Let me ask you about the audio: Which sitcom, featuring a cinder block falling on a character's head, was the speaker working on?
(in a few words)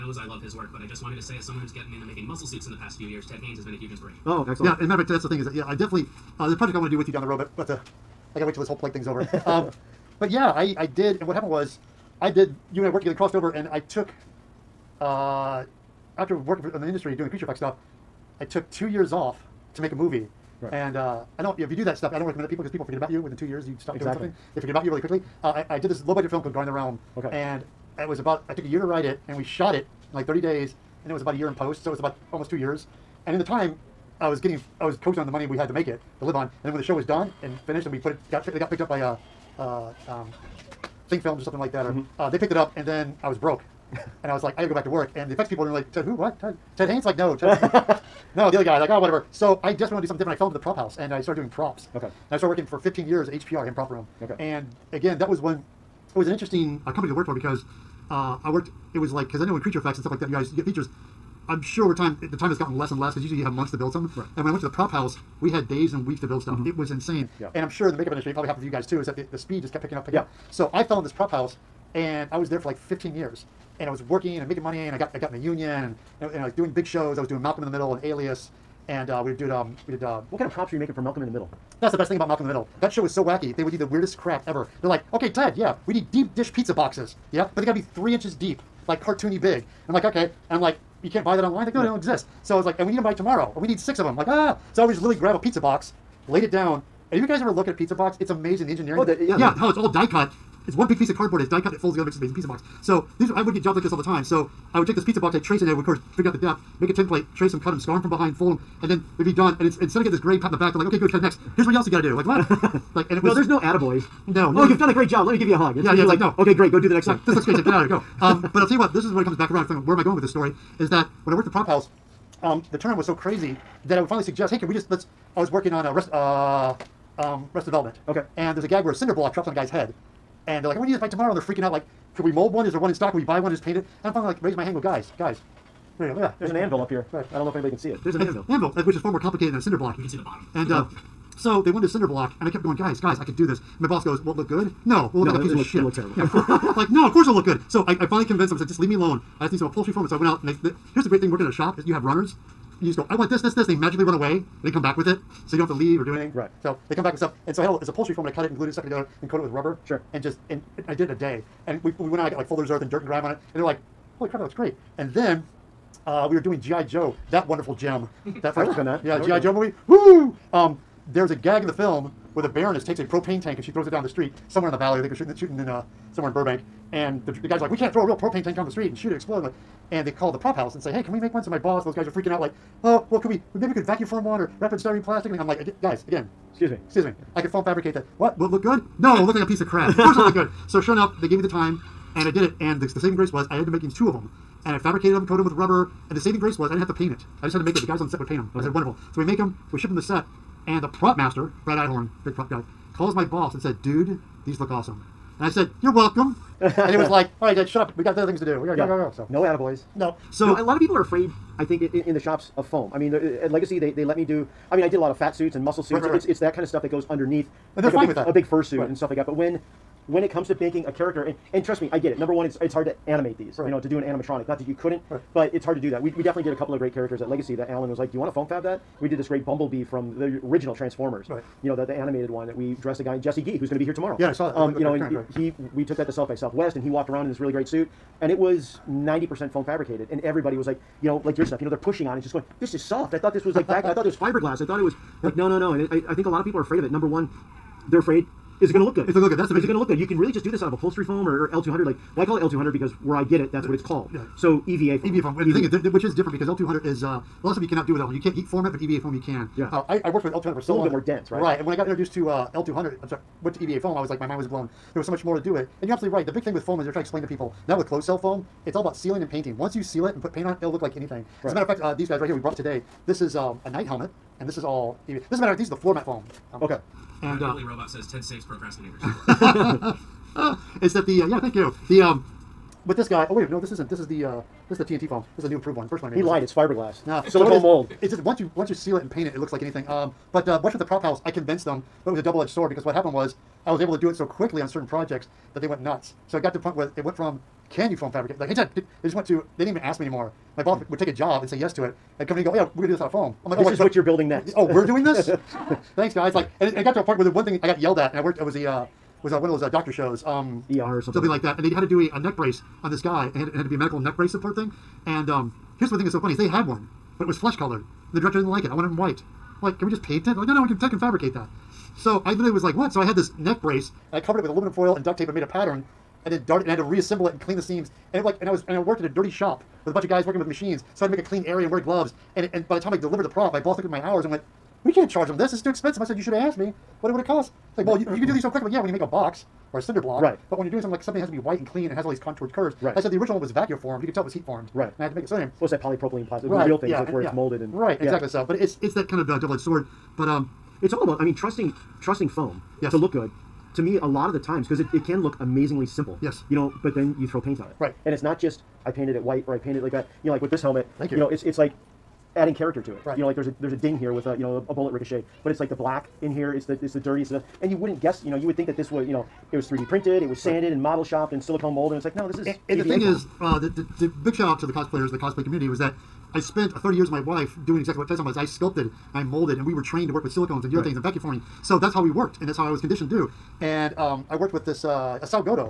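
Arrested Development.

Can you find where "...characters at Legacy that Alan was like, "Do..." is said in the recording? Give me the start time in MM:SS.
03:46.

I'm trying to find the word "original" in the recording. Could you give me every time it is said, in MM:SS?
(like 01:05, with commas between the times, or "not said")
03:50, 05:43.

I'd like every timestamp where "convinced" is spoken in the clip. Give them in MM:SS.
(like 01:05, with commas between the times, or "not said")
02:28, 04:51.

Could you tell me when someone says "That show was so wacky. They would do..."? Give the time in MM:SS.
01:22.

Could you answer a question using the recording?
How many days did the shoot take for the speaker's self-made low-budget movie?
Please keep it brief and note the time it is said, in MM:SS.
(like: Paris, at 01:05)
30, at 00:30.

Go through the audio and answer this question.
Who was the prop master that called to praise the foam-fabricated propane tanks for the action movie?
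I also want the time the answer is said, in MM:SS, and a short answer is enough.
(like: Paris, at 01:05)
Brad Einhorn, at 03:21.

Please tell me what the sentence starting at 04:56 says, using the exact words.
So it got to the point where it went from, can you foam fabricate?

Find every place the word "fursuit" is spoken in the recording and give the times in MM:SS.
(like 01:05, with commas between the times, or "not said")
03:38.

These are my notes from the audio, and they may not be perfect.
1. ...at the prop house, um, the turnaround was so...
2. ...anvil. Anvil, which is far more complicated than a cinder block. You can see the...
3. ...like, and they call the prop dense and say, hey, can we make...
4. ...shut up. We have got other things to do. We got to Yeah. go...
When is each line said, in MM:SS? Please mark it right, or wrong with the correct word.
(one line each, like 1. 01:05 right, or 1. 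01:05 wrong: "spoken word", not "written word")
1. 02:01 right
2. 02:18 right
3. 02:59 wrong: "house", not "dense"
4. 03:27 right.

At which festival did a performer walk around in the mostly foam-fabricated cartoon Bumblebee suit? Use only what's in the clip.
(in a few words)
South by Southwest.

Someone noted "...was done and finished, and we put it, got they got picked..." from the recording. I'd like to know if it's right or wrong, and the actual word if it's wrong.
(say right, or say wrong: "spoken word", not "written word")
right.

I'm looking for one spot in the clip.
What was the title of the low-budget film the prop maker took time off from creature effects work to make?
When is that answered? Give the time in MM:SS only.
00:26.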